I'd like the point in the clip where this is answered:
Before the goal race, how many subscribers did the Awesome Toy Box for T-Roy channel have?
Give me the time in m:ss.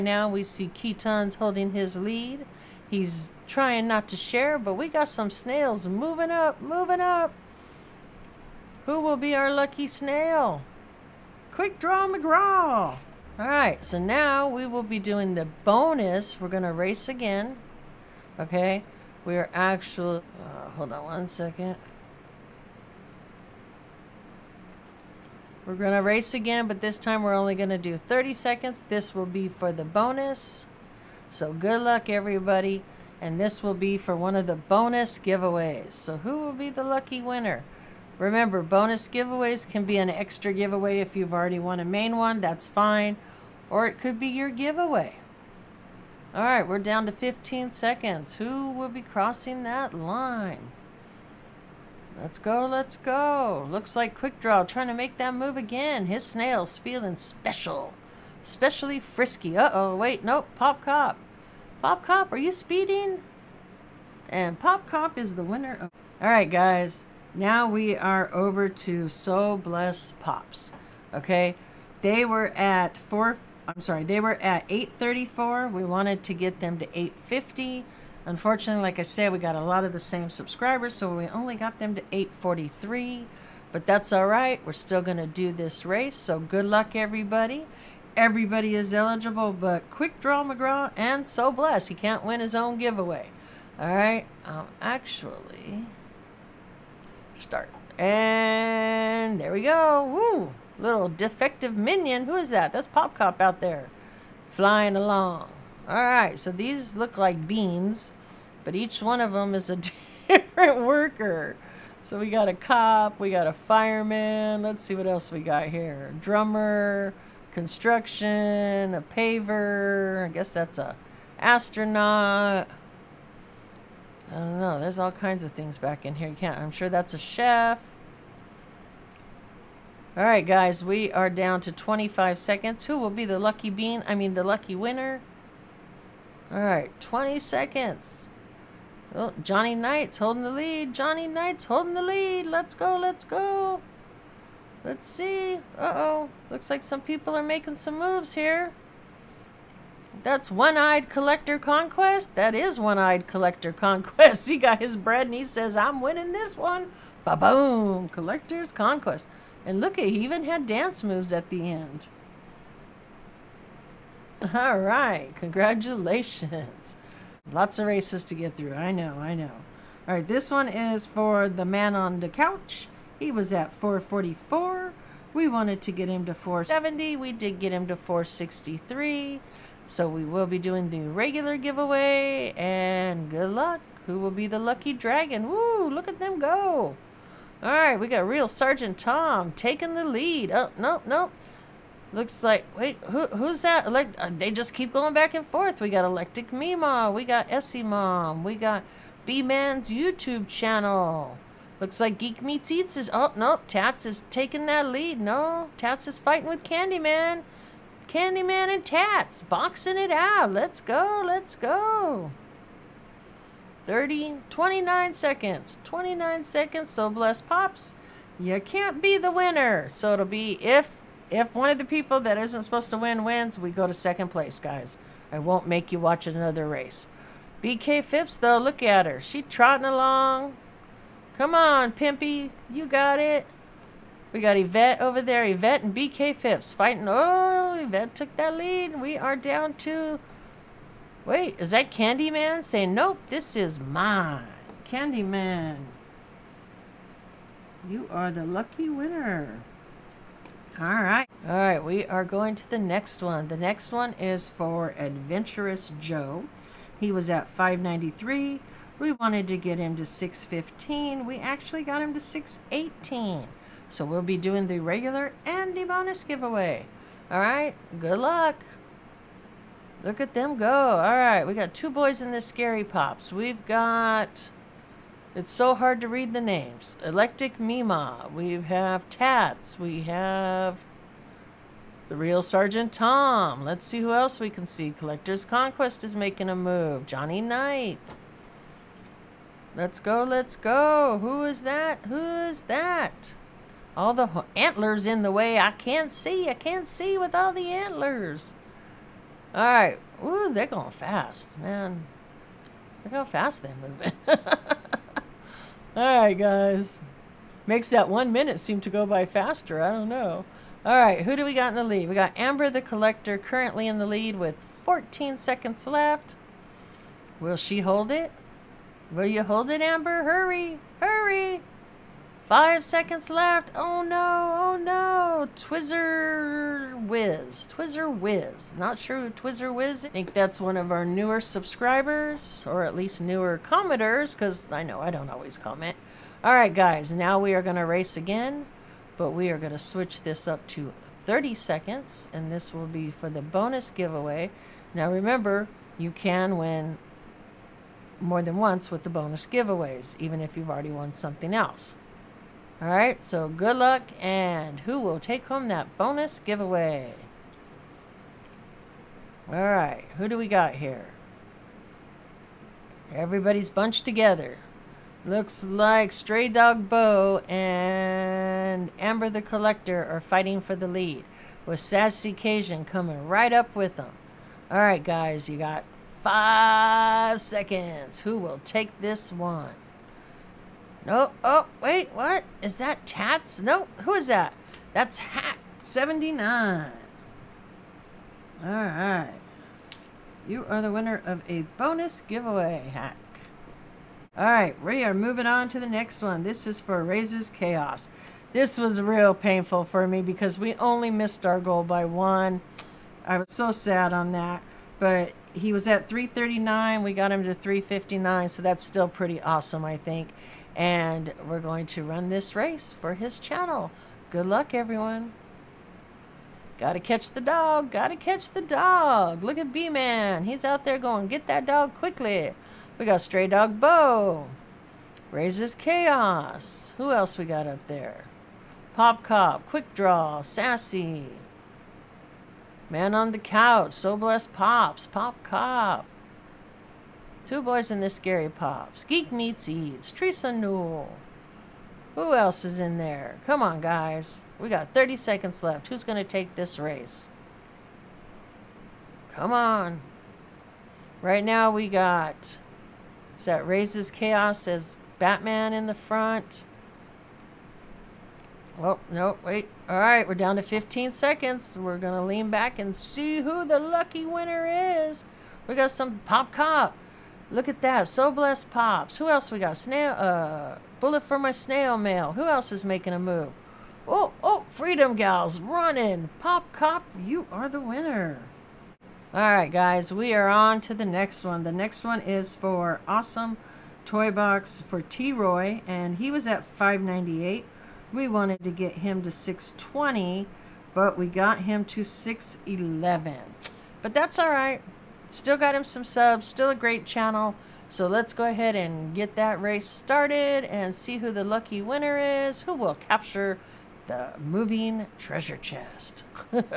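8:06.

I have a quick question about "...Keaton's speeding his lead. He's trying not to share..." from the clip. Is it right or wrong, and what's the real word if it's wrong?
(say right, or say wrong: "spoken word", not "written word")
wrong: "holding", not "speeding".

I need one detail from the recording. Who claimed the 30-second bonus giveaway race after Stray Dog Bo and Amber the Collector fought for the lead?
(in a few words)
Hack 79.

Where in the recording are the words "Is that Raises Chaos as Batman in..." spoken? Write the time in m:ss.
7:33.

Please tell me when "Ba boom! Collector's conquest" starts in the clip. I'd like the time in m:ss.
2:37.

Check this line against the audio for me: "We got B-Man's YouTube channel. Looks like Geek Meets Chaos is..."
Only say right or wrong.
wrong.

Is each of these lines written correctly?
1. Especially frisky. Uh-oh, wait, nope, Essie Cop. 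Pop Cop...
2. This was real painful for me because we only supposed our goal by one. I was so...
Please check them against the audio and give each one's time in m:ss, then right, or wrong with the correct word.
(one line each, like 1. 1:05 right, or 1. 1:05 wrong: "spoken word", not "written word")
1. 0:58 wrong: "Pop", not "Essie"
2. 6:38 wrong: "missed", not "supposed".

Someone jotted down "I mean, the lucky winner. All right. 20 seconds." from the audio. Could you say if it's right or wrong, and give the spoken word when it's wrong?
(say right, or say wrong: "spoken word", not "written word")
right.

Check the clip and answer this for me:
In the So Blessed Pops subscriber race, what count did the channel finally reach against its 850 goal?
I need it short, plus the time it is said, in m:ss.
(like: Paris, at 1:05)
843, at 1:22.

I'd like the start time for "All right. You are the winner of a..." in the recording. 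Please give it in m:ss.
6:28.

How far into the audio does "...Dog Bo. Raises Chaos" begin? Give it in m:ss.
7:03.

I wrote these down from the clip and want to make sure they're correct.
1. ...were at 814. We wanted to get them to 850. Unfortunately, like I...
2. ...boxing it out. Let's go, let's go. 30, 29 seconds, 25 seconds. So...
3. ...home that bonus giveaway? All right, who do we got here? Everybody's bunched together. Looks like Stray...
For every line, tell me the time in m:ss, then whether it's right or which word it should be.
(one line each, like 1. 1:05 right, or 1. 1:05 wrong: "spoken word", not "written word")
1. 1:14 wrong: "834", not "814"
2. 3:29 wrong: "29", not "25"
3. 5:55 right.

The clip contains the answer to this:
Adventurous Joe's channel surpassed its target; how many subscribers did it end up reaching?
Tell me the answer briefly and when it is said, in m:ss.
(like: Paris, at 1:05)
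618, at 4:22.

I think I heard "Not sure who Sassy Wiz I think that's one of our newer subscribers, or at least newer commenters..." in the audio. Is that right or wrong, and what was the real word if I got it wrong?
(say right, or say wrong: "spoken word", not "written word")
wrong: "Twizzer", not "Sassy".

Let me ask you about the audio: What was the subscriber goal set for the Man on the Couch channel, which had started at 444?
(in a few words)
470.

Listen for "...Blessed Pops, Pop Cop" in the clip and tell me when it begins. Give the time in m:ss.
7:14.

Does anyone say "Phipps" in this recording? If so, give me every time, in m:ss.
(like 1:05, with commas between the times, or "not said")
3:48, 3:56.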